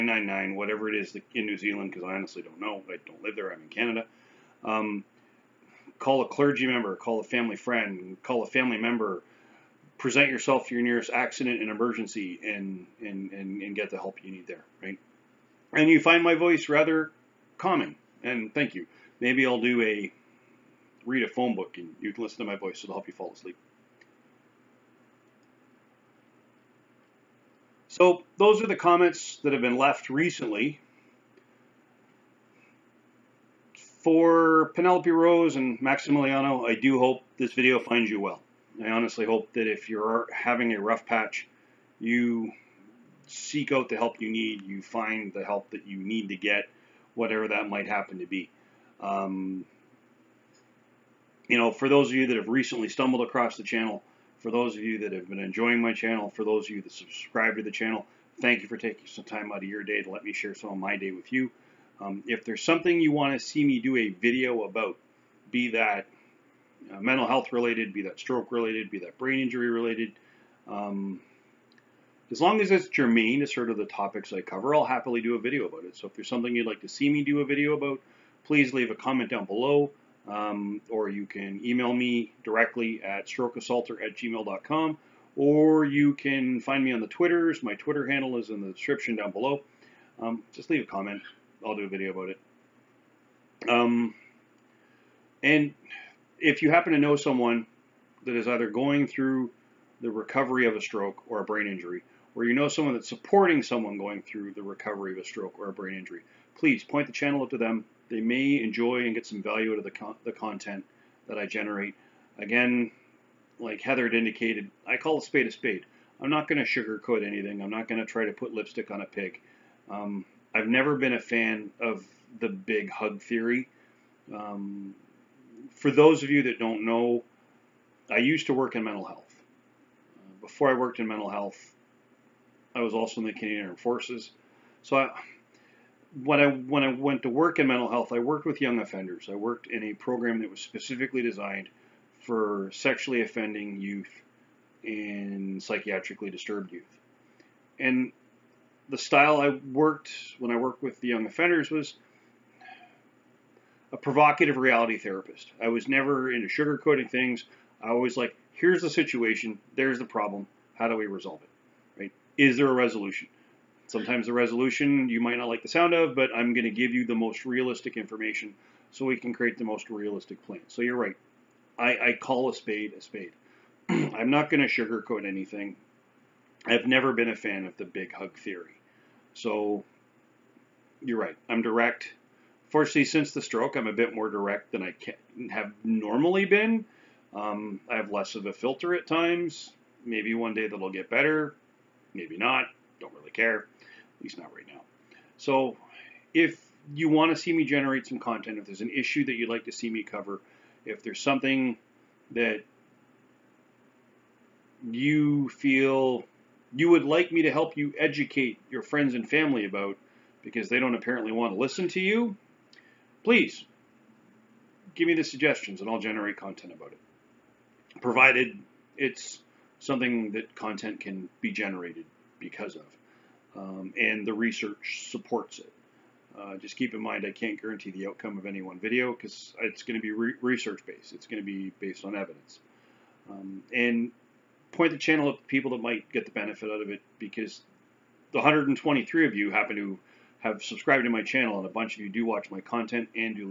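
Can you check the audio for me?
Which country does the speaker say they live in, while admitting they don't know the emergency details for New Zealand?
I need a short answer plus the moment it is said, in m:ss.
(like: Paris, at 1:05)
Canada, at 0:03.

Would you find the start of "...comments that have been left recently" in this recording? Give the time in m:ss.
0:28.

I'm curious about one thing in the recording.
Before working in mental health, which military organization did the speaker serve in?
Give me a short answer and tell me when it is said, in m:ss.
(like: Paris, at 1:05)
Canadian Armed Forces, at 2:13.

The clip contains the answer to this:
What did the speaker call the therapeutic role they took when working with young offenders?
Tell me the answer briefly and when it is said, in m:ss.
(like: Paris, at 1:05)
provocative reality therapist, at 2:33.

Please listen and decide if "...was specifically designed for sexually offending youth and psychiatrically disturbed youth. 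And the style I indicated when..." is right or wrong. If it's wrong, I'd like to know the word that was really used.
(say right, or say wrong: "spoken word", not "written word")
wrong: "worked", not "indicated".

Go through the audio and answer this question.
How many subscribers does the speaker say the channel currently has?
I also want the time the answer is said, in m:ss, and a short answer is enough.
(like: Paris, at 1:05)
123, at 3:58.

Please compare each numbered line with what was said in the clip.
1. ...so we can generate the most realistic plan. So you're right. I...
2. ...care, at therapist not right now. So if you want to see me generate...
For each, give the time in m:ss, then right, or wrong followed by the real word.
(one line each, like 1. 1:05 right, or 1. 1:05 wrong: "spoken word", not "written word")
1. 2:48 wrong: "create", not "generate"
2. 3:13 wrong: "least", not "therapist".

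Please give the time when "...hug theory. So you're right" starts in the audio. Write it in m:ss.
2:58.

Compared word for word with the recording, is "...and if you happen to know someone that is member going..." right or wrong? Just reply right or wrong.
wrong.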